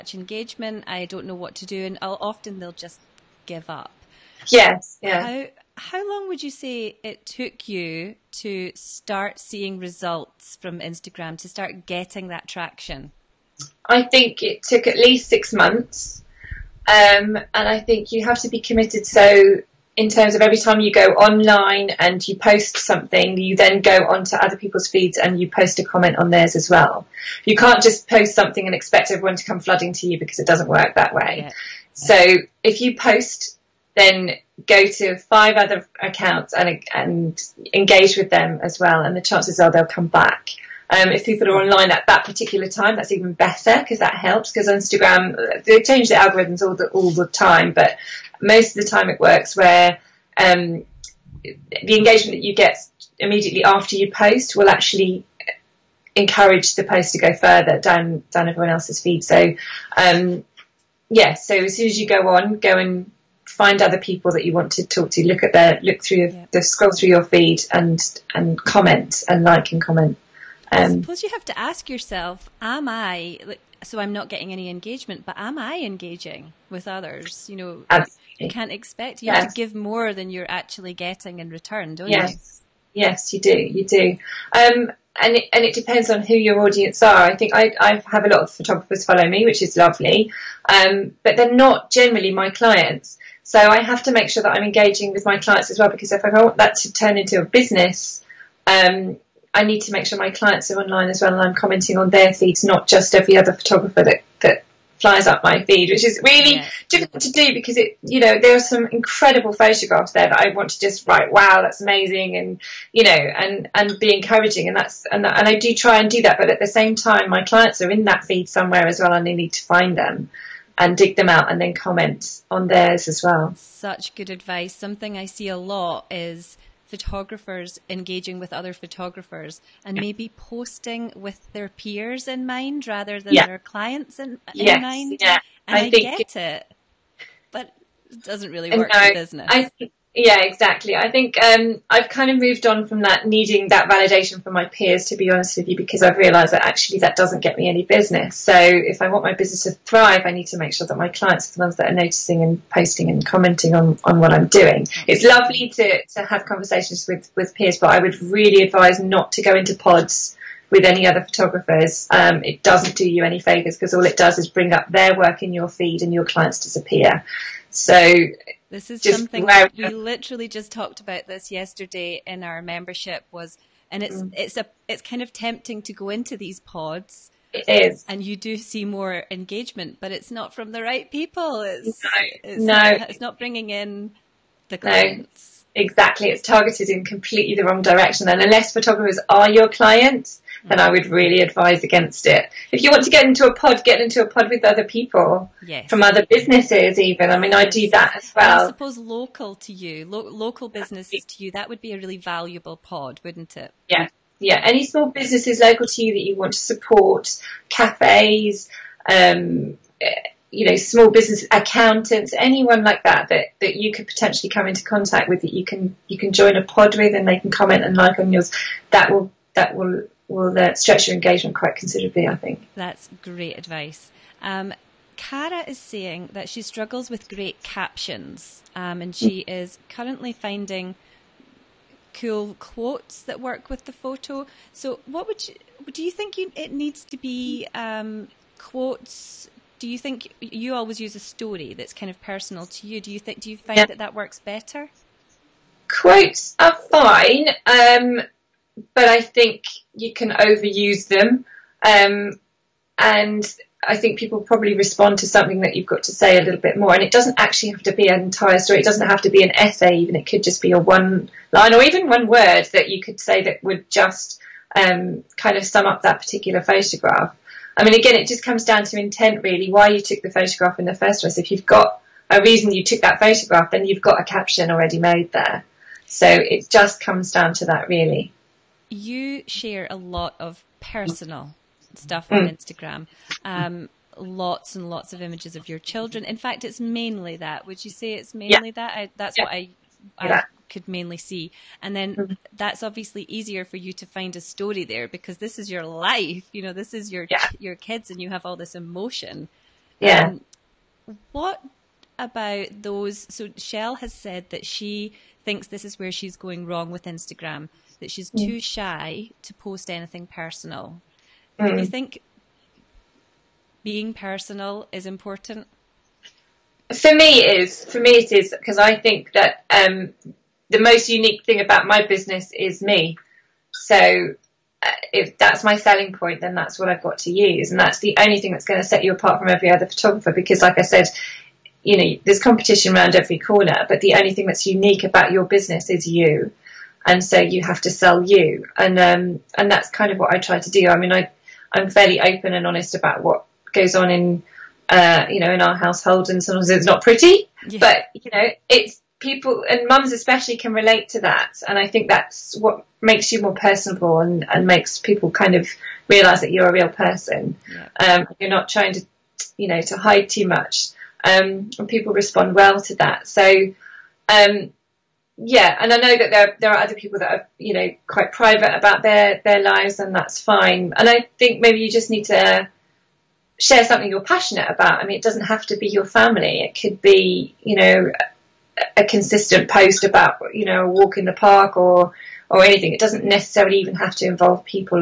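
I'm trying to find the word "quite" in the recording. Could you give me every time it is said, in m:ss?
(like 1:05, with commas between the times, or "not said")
3:41, 6:08.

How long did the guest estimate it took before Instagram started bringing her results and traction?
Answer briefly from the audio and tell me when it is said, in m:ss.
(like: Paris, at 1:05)
at least 6 months, at 0:14.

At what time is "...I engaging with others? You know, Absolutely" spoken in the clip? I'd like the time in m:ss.
1:15.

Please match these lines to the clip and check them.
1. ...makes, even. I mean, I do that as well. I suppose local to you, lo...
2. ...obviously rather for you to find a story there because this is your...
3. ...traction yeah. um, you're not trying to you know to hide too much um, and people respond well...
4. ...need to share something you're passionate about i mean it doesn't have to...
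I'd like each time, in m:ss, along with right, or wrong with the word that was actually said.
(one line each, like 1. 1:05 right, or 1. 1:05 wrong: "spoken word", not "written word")
1. 3:16 wrong: "businesses", not "makes"
2. 4:52 wrong: "easier", not "rather"
3. 5:56 wrong: "person", not "traction"
4. 6:12 right.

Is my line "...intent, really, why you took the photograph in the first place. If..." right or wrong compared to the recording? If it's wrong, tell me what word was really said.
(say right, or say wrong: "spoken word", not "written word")
right.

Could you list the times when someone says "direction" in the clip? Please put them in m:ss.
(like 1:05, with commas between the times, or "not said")
3:07.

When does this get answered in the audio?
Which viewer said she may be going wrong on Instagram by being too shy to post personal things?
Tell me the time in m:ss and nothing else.
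5:03.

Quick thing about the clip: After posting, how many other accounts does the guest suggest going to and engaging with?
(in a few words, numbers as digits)
5.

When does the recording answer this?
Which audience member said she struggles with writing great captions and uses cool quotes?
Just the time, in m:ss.
3:45.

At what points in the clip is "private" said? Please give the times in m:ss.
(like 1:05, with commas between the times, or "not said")
6:08.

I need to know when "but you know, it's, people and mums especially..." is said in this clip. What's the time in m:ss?
5:47.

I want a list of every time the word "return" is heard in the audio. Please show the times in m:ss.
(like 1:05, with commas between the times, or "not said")
1:21.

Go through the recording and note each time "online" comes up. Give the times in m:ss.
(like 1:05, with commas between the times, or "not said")
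0:21, 0:41, 1:40.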